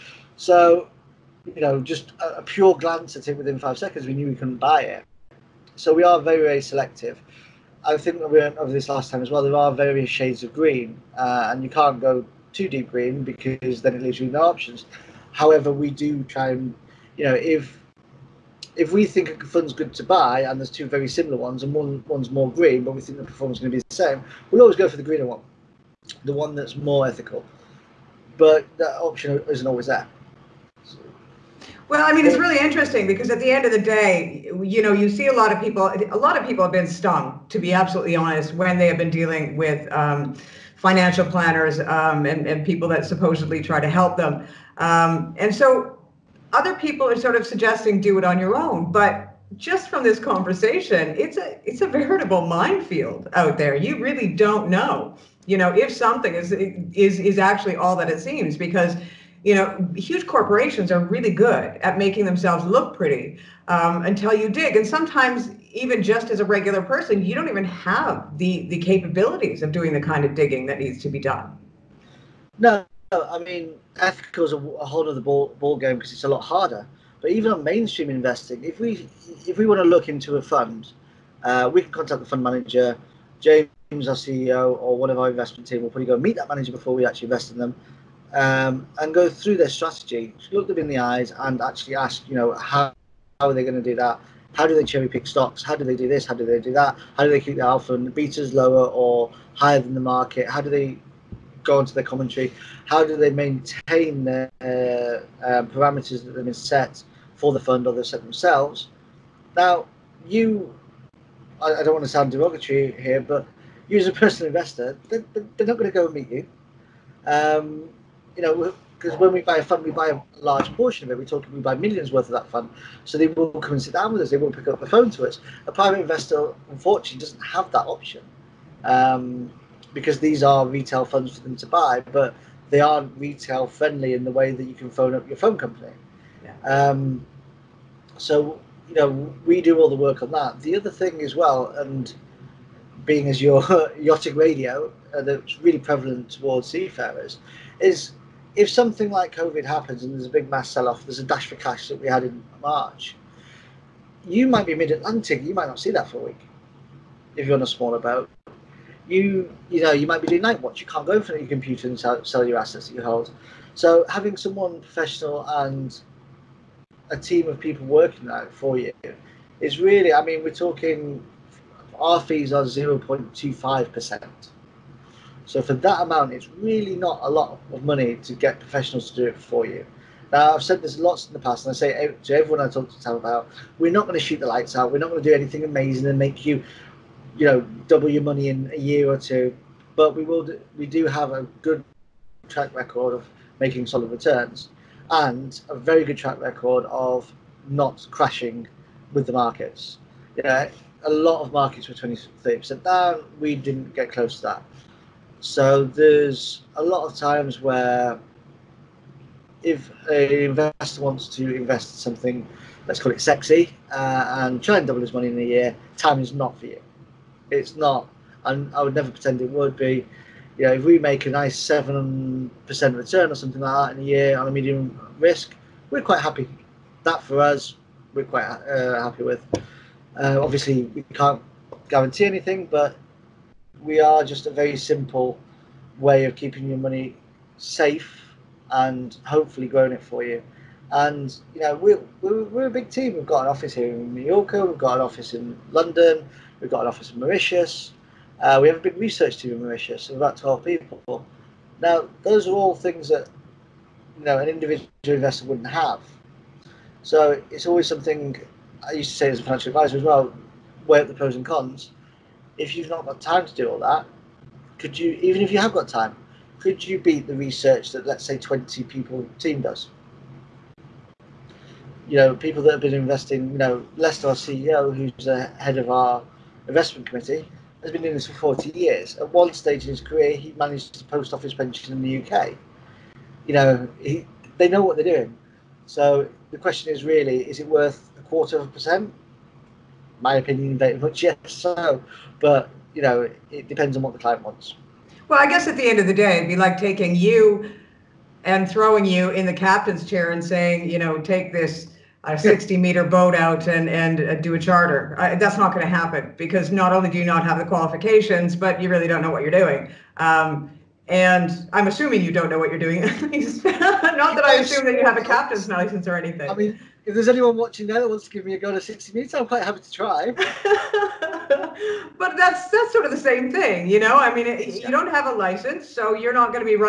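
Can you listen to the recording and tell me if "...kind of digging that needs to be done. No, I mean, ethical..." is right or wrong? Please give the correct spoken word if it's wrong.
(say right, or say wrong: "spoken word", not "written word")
right.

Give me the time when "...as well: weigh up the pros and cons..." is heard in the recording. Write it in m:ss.
4:19.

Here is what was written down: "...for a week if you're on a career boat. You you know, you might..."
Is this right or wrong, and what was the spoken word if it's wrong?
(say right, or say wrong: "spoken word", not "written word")
wrong: "smaller", not "career".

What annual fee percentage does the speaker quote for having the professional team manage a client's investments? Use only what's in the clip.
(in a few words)
0.25%.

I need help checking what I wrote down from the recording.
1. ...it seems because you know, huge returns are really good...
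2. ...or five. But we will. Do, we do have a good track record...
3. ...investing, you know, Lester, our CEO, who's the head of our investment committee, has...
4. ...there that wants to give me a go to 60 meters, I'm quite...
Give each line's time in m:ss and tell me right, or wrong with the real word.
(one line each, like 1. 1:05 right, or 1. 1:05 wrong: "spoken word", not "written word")
1. 0:58 wrong: "corporations", not "returns"
2. 3:09 wrong: "two", not "five"
3. 4:32 right
4. 5:17 right.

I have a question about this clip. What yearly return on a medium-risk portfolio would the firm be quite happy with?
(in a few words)
7%.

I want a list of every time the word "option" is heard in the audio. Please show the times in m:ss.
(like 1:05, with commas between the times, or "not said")
0:14, 0:28, 2:07.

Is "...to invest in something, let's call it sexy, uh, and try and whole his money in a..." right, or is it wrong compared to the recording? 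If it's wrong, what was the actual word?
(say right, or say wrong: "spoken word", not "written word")
wrong: "double", not "whole".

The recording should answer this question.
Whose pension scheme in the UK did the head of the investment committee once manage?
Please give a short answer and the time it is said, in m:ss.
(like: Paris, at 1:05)
The Post Office, at 4:41.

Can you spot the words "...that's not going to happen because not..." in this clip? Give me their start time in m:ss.
5:05.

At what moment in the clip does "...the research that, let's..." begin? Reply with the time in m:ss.
4:27.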